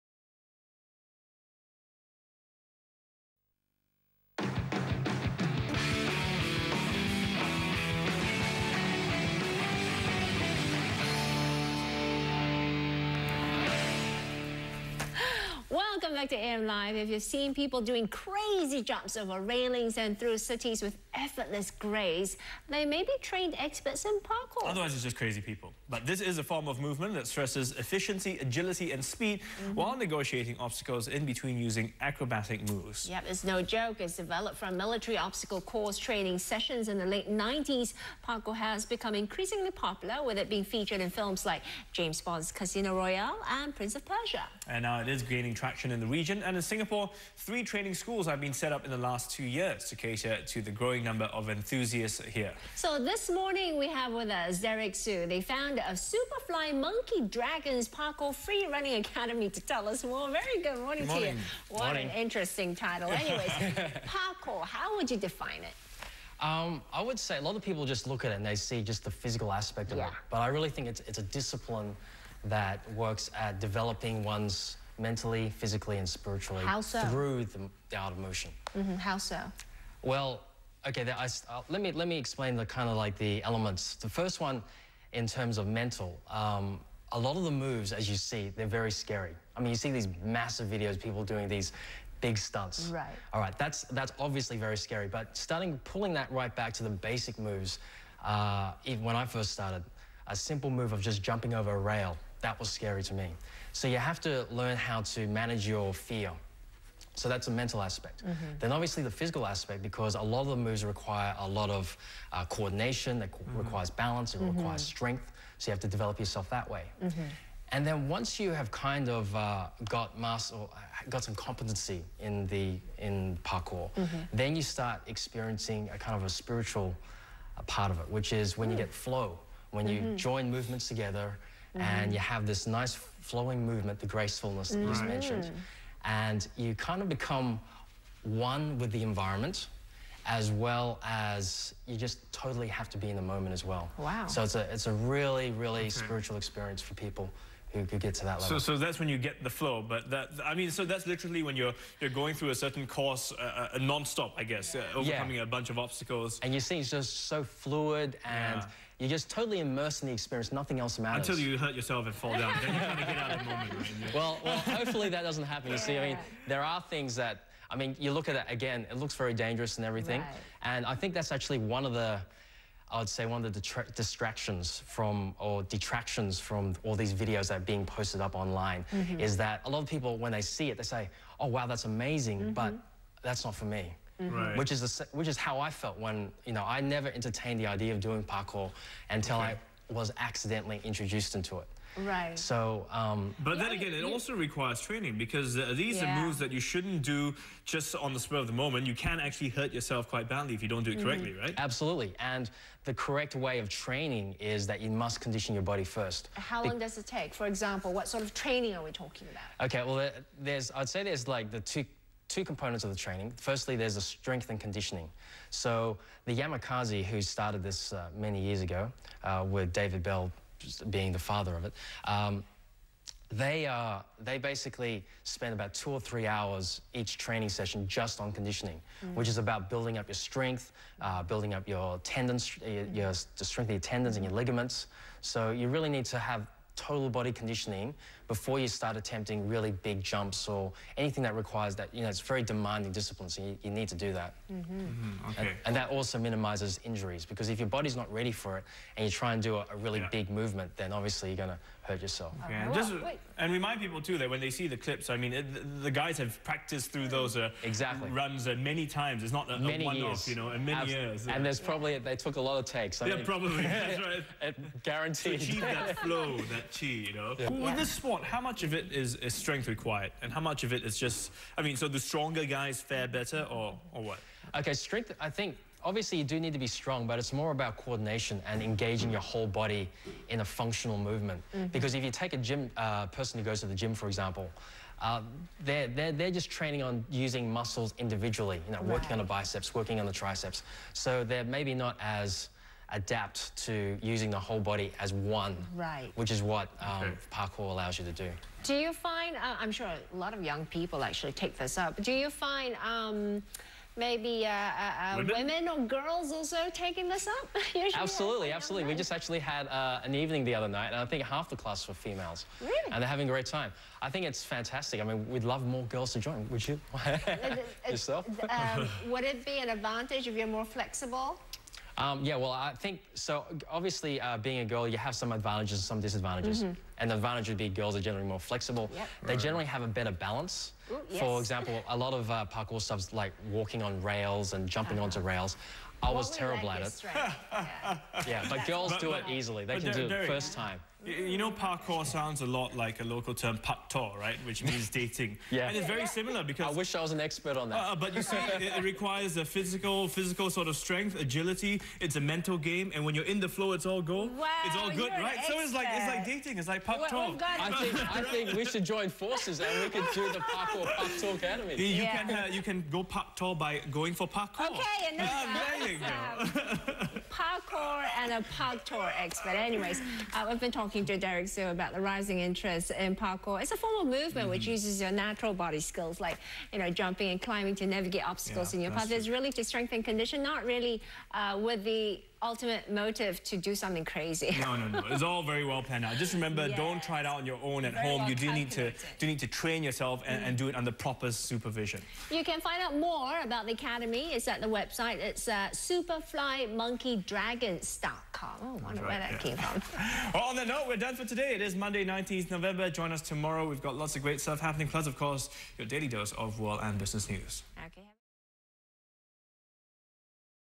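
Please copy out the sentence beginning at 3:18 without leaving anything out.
You can actually hurt yourself quite badly if you don't do it mm-hmm.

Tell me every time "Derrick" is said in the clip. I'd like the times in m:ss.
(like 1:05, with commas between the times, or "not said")
0:54, 6:11.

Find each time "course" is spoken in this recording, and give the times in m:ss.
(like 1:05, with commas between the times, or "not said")
0:35, 2:32, 6:45.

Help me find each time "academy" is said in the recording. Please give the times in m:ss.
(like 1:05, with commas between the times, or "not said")
0:58, 6:01, 6:33.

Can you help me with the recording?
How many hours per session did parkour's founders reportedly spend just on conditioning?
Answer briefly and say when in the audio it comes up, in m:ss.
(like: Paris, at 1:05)
2 or 3 hours, at 3:45.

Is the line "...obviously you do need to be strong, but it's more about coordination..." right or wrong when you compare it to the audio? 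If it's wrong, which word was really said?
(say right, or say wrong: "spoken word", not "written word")
right.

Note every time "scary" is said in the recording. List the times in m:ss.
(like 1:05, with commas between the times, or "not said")
1:28, 1:34, 1:42.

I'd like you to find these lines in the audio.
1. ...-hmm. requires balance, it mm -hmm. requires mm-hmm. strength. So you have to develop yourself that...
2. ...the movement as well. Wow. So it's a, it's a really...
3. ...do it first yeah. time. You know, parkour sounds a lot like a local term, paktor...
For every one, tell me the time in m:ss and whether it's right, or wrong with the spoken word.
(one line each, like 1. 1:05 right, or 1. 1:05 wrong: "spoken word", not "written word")
1. 1:53 right
2. 2:23 wrong: "moment", not "movement"
3. 5:39 right.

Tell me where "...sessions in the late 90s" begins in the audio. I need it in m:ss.
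0:36.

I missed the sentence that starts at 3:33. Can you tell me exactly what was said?
Firstly, there's the strength and conditioning.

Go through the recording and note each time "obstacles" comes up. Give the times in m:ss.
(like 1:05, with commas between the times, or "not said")
0:30, 0:35, 2:35, 6:18.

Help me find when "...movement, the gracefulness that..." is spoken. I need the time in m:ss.
2:13.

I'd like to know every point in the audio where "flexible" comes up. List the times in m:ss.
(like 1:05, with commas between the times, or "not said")
5:20, 5:28.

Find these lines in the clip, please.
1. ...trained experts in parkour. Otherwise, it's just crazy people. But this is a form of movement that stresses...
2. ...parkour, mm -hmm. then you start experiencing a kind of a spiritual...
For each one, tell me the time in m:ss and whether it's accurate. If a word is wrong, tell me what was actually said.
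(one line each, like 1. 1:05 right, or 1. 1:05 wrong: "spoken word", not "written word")
1. 0:23 right
2. 2:03 right.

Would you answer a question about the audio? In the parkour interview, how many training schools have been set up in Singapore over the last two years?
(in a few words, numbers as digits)
3.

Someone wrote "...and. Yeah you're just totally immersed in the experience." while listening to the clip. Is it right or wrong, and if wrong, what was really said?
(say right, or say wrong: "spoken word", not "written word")
right.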